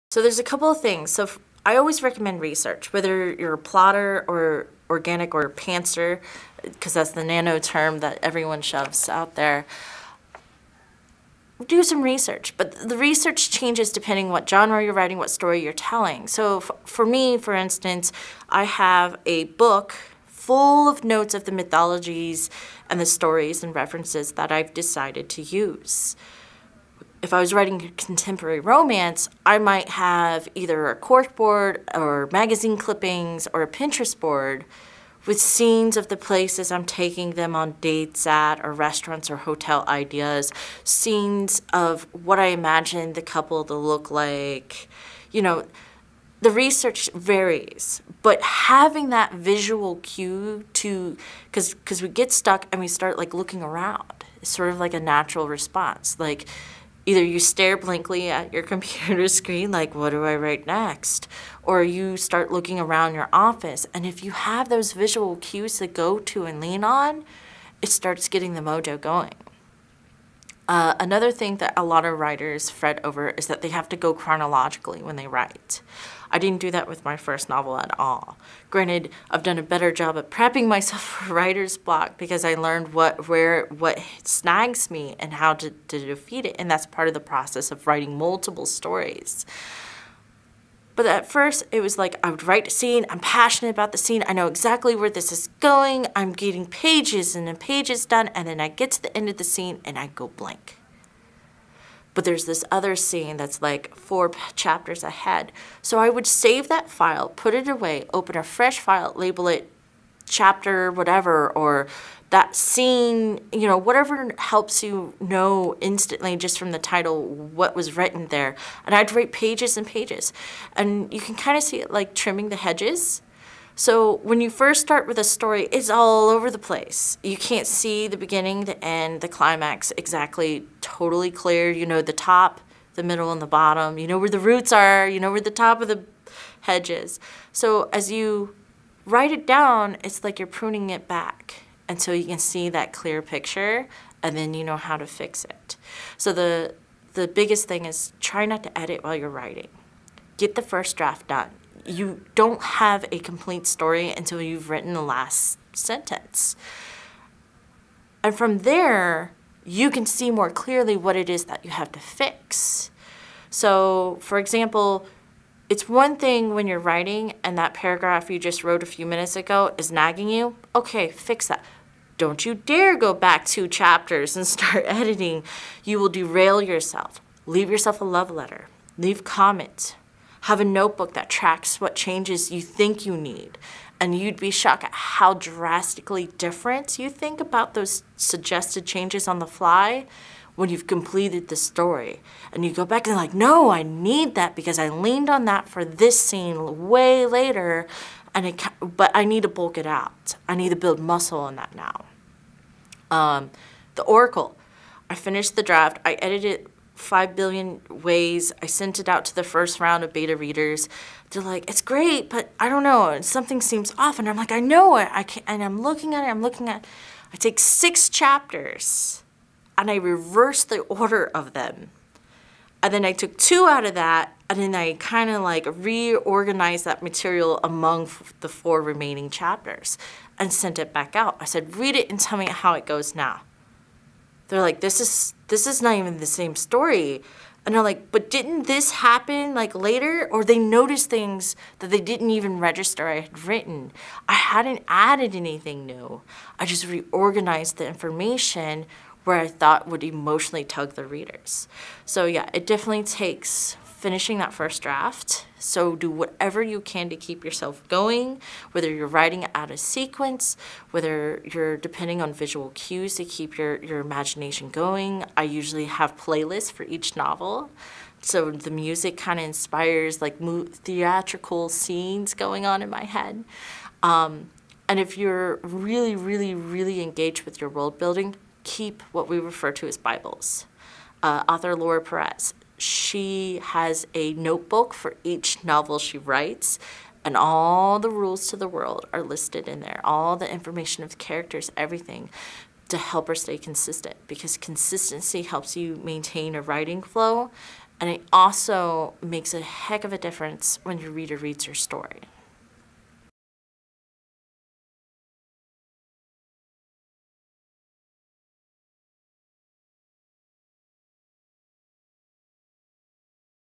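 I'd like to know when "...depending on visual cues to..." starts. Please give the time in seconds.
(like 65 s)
261 s.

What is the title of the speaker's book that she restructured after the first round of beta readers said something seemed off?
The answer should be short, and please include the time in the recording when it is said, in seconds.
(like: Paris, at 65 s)
The Oracle, at 203 s.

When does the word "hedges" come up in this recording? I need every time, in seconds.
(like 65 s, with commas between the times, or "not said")
122 s, 136 s.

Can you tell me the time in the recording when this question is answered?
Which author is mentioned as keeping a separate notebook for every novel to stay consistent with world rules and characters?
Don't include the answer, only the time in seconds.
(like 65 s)
281 s.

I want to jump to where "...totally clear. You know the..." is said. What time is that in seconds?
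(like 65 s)
130 s.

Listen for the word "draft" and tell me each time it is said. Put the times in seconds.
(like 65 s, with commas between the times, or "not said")
150 s, 205 s, 254 s.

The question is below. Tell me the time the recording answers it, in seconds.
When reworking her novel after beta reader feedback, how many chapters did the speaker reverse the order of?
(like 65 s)
217 s.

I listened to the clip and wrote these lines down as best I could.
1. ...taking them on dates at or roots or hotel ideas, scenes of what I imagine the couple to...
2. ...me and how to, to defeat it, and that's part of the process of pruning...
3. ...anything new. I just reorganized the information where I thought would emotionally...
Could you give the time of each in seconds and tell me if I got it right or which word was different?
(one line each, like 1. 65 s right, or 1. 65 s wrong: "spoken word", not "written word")
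1. 36 s wrong: "restaurants", not "roots"
2. 84 s wrong: "writing", not "pruning"
3. 245 s right.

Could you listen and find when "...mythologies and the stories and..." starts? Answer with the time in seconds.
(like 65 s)
21 s.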